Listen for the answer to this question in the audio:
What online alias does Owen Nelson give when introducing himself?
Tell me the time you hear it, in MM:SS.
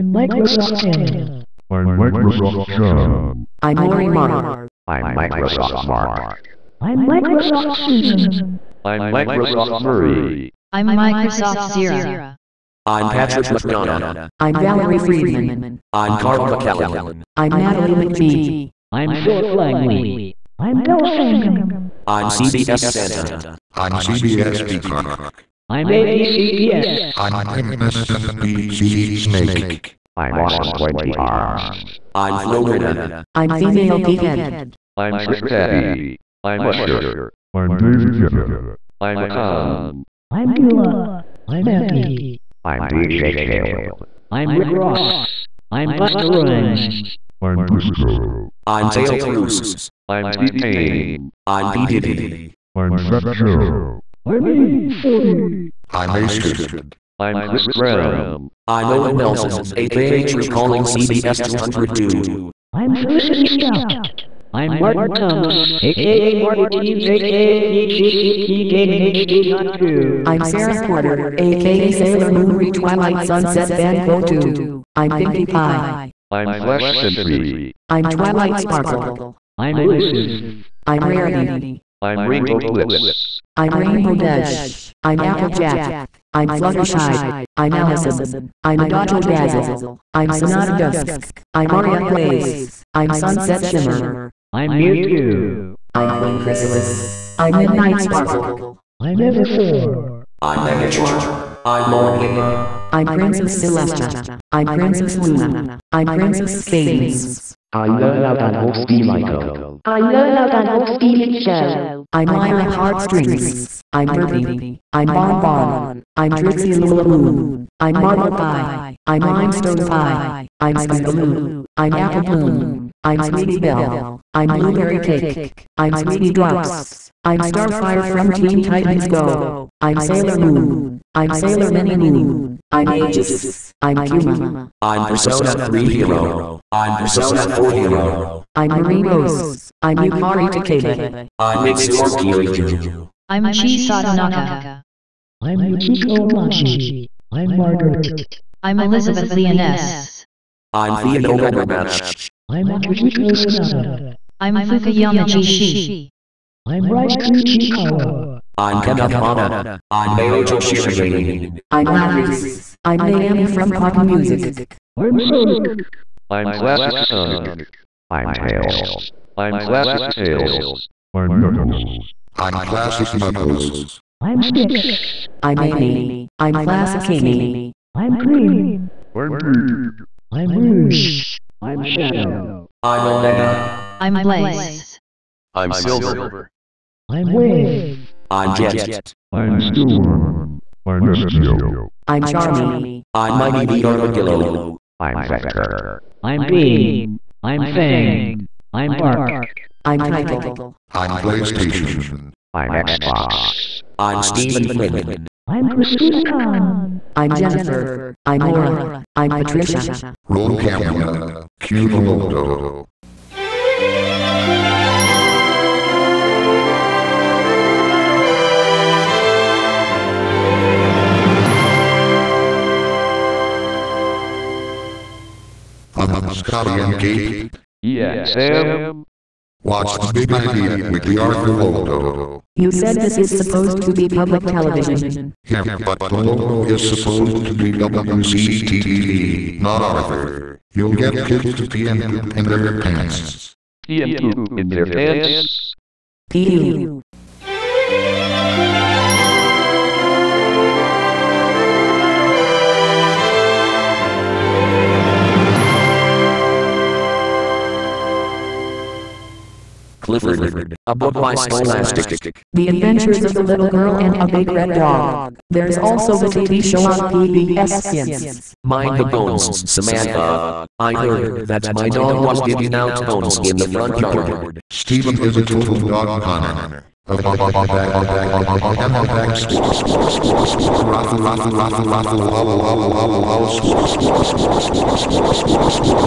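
01:00.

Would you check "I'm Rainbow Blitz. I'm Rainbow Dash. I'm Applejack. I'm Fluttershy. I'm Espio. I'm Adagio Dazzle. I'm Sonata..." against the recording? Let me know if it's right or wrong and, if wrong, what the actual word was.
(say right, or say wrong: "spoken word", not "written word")
wrong: "Allison", not "Espio".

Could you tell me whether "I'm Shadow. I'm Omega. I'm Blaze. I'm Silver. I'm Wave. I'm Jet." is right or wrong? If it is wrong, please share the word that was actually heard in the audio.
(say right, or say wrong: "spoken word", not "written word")
right.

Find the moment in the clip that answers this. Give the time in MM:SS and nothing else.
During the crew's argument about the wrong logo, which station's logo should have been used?
03:57.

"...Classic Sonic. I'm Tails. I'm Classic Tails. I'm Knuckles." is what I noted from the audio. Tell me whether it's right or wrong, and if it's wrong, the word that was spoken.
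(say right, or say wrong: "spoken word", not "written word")
right.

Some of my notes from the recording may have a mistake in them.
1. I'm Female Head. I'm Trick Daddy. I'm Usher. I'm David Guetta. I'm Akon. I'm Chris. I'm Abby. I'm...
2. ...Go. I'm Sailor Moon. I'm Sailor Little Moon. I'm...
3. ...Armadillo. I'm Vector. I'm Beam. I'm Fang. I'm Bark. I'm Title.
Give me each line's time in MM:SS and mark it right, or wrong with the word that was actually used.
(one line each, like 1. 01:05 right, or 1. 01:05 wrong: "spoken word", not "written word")
1. 00:33 wrong: "Beulah", not "Chris"
2. 02:09 wrong: "Mini", not "Little"
3. 03:13 right.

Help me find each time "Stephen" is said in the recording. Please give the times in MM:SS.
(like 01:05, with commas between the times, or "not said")
03:24, 04:34.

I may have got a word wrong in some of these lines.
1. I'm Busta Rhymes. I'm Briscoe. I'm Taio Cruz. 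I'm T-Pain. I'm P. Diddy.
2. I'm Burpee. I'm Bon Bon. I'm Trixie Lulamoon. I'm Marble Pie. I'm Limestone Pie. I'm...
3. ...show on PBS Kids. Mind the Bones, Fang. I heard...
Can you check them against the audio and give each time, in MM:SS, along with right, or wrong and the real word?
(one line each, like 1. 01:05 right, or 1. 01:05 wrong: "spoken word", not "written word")
1. 00:45 right
2. 01:53 right
3. 04:26 wrong: "Samantha", not "Fang".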